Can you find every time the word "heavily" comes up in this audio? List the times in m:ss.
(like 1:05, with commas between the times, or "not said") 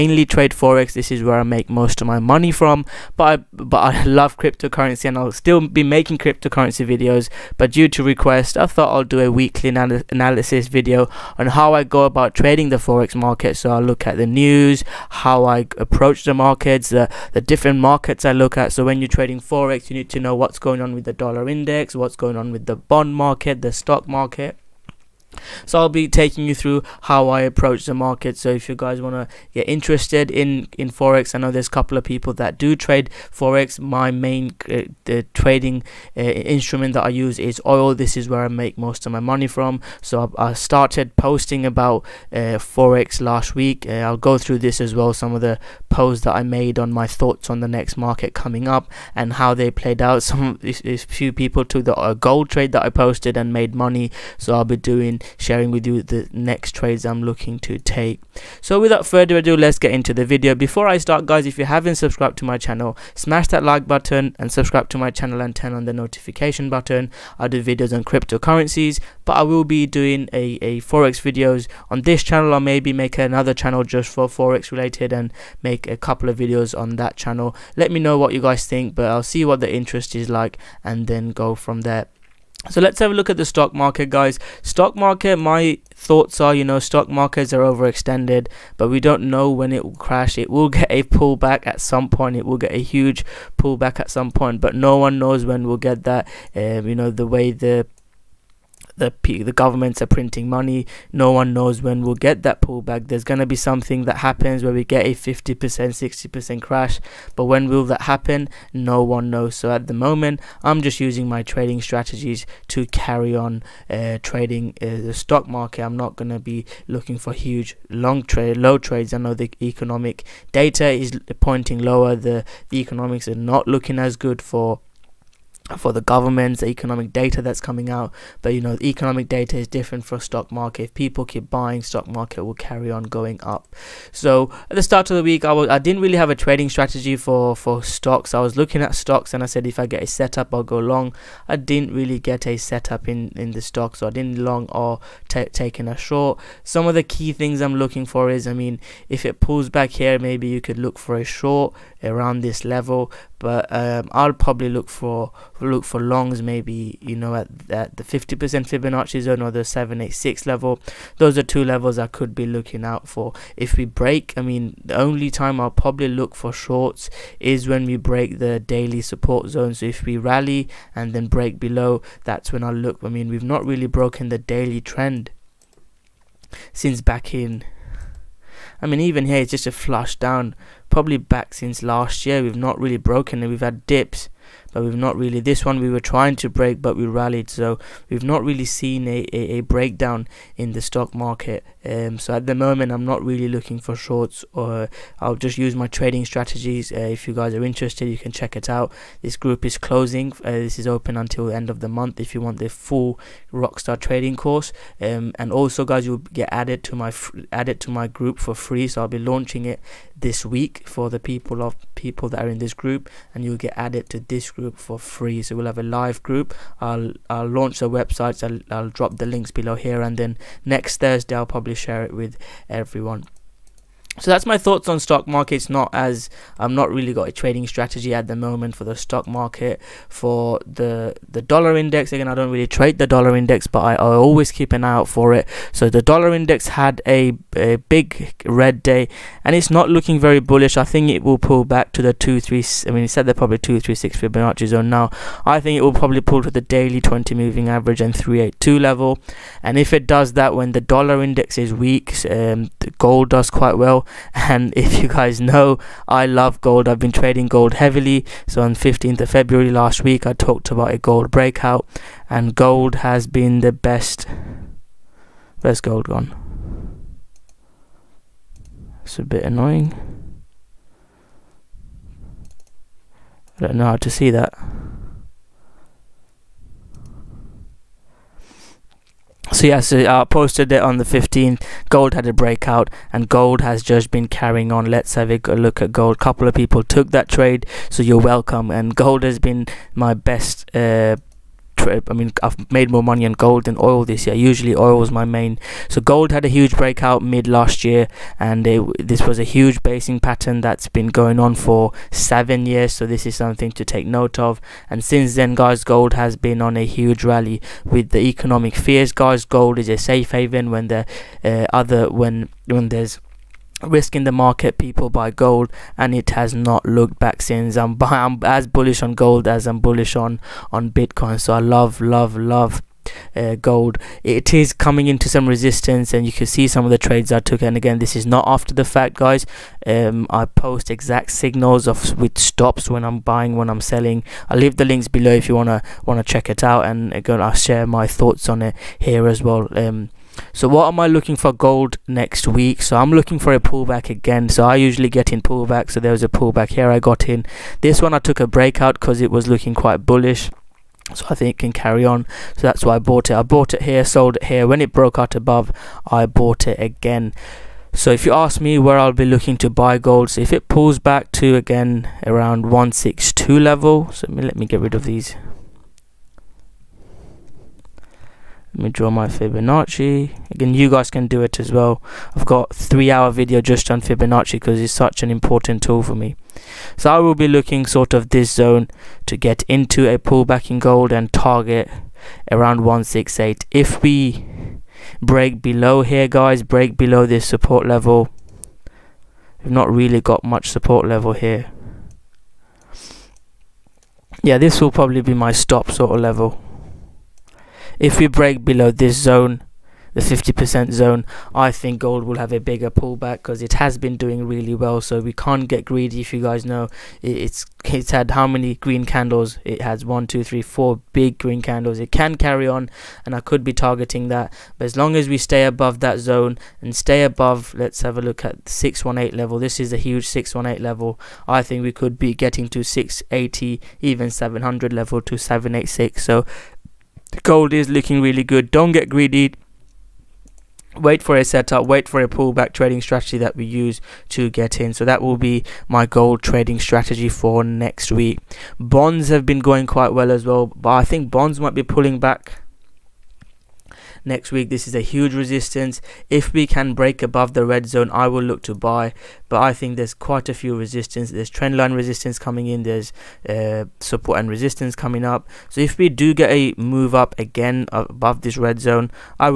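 4:17.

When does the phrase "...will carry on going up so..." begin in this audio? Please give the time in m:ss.
2:12.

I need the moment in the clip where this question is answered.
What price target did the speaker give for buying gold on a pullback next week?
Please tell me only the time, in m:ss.
6:22.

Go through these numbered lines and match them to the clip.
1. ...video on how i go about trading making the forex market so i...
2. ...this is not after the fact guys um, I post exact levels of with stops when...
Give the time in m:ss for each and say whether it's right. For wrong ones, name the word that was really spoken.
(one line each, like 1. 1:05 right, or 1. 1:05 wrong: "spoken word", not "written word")
1. 0:10 wrong: "trading", not "making"
2. 5:27 wrong: "signals", not "levels".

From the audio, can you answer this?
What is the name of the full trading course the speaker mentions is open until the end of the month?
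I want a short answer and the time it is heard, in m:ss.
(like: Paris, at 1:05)
Rockstar trading course, at 3:23.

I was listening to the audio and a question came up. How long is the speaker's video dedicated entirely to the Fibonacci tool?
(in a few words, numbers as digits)
3 hours.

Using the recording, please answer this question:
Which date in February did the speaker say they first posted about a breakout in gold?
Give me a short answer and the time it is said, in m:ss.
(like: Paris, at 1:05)
15th of February, at 4:18.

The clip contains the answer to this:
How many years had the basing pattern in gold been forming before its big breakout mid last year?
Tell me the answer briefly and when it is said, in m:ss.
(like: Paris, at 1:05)
7, at 5:02.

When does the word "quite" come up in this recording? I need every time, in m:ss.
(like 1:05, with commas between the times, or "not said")
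4:13, 5:49, 7:19, 7:30.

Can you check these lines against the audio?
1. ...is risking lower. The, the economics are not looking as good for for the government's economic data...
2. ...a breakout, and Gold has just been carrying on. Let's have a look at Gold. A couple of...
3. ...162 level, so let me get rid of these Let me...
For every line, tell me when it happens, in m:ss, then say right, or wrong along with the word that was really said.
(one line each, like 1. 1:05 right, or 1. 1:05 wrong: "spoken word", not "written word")
1. 2:00 wrong: "pointing", not "risking"
2. 4:42 right
3. 6:02 right.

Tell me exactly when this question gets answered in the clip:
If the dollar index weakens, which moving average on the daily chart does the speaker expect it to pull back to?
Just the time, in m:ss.
4:06.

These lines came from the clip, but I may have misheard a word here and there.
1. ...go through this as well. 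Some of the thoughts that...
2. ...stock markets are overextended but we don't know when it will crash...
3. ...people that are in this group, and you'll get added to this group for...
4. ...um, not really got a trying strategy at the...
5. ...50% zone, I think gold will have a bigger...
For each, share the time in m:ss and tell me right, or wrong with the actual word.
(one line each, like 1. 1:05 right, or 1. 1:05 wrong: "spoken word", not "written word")
1. 0:44 wrong: "posts", not "thoughts"
2. 1:26 right
3. 3:31 right
4. 3:46 wrong: "trading", not "trying"
5. 6:40 right.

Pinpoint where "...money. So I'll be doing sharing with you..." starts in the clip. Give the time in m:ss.
0:53.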